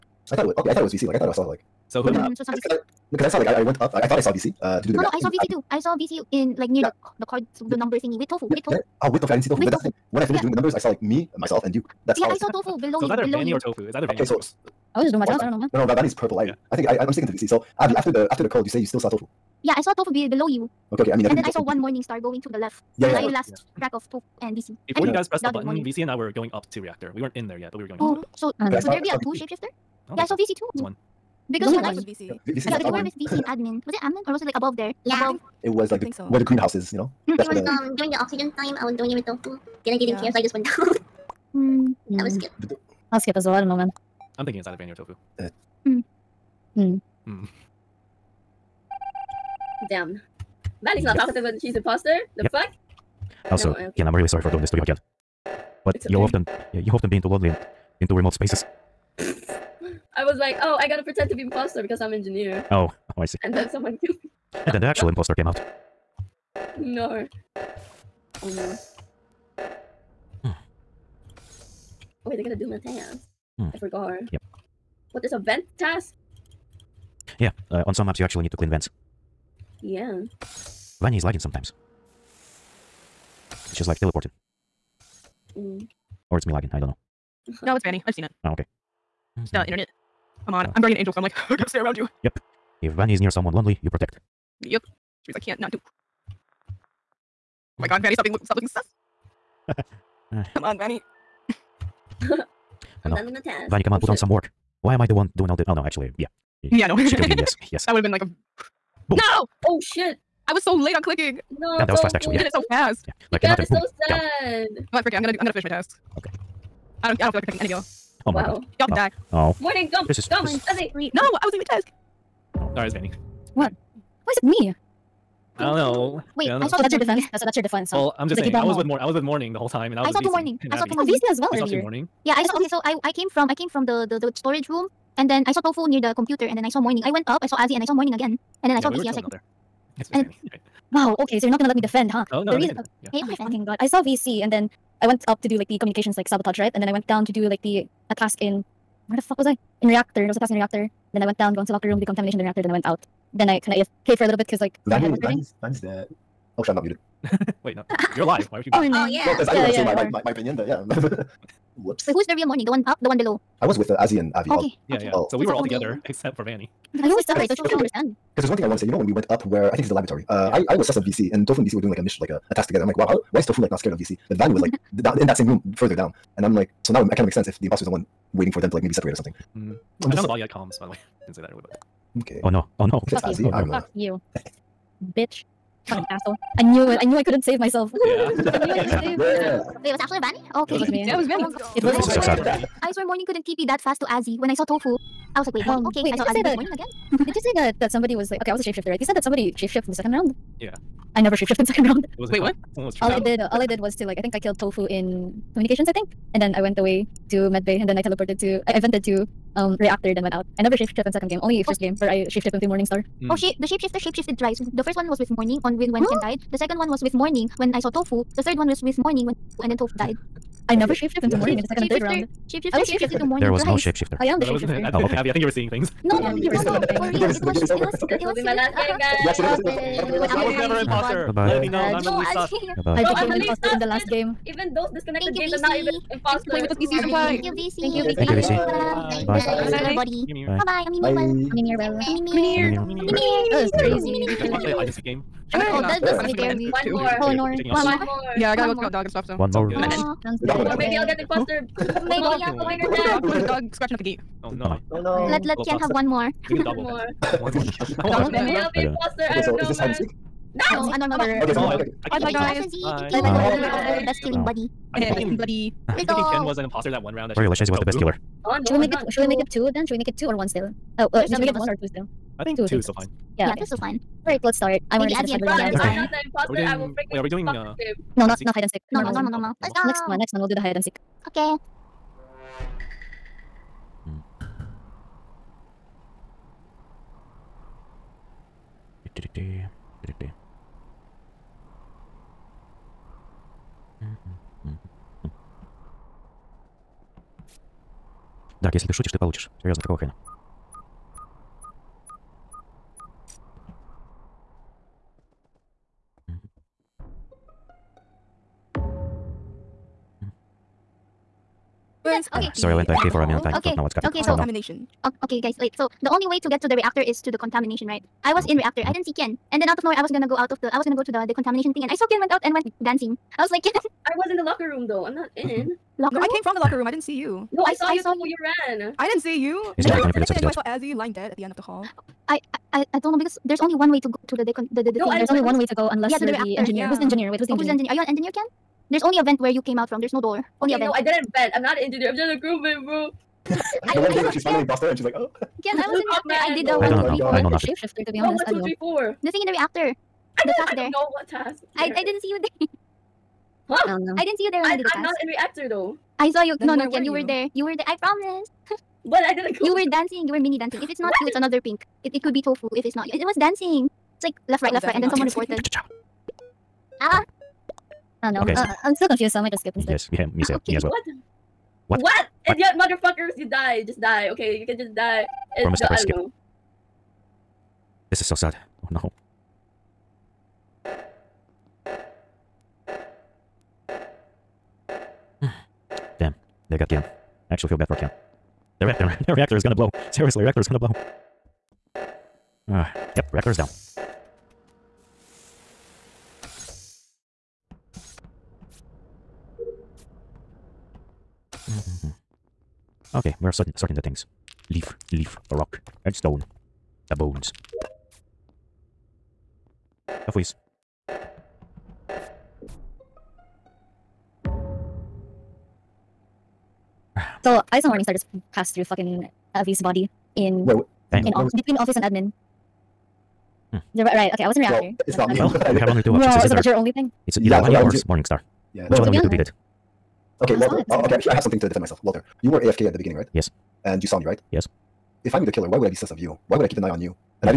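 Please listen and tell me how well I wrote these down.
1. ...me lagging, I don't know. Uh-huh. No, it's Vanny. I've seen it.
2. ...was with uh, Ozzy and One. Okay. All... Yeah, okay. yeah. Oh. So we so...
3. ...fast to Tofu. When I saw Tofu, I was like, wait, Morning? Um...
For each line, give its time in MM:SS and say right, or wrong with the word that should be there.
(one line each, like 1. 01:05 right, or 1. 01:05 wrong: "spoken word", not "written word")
1. 01:26 right
2. 02:43 wrong: "Avi", not "One"
3. 03:13 wrong: "Azzy", not "Tofu".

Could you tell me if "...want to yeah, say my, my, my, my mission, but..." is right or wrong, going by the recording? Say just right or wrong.
wrong.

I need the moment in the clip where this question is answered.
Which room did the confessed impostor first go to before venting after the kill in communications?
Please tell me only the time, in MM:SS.
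03:27.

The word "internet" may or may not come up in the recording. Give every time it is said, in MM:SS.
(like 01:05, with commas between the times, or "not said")
01:29.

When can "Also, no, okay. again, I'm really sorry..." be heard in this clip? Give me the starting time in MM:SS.
00:53.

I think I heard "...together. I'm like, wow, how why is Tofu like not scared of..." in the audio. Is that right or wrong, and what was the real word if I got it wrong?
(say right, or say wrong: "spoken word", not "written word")
right.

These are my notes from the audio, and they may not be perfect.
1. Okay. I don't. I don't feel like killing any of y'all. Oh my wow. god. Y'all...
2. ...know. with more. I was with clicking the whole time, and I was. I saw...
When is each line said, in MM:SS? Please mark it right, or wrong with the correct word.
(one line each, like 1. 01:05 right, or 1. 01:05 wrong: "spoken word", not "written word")
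1. 01:56 wrong: "protecting", not "killing"
2. 02:08 wrong: "morning", not "clicking".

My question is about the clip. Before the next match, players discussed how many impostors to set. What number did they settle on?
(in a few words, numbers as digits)
2.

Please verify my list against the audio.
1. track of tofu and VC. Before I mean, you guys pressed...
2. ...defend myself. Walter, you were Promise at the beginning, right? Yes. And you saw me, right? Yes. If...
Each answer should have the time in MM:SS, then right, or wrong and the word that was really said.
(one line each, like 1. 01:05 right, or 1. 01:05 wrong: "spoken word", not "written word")
1. 00:23 right
2. 07:11 wrong: "AFK", not "Promise".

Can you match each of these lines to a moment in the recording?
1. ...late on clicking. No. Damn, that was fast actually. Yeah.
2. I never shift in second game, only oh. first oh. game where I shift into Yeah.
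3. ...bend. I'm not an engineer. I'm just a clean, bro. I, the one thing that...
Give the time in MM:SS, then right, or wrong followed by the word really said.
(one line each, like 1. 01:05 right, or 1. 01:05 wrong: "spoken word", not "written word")
1. 01:50 right
2. 03:30 wrong: "Morningstar", not "Yeah"
3. 05:41 wrong: "crewman", not "clean".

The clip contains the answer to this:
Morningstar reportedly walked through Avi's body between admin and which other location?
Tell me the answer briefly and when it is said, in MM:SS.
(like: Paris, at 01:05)
Office, at 07:01.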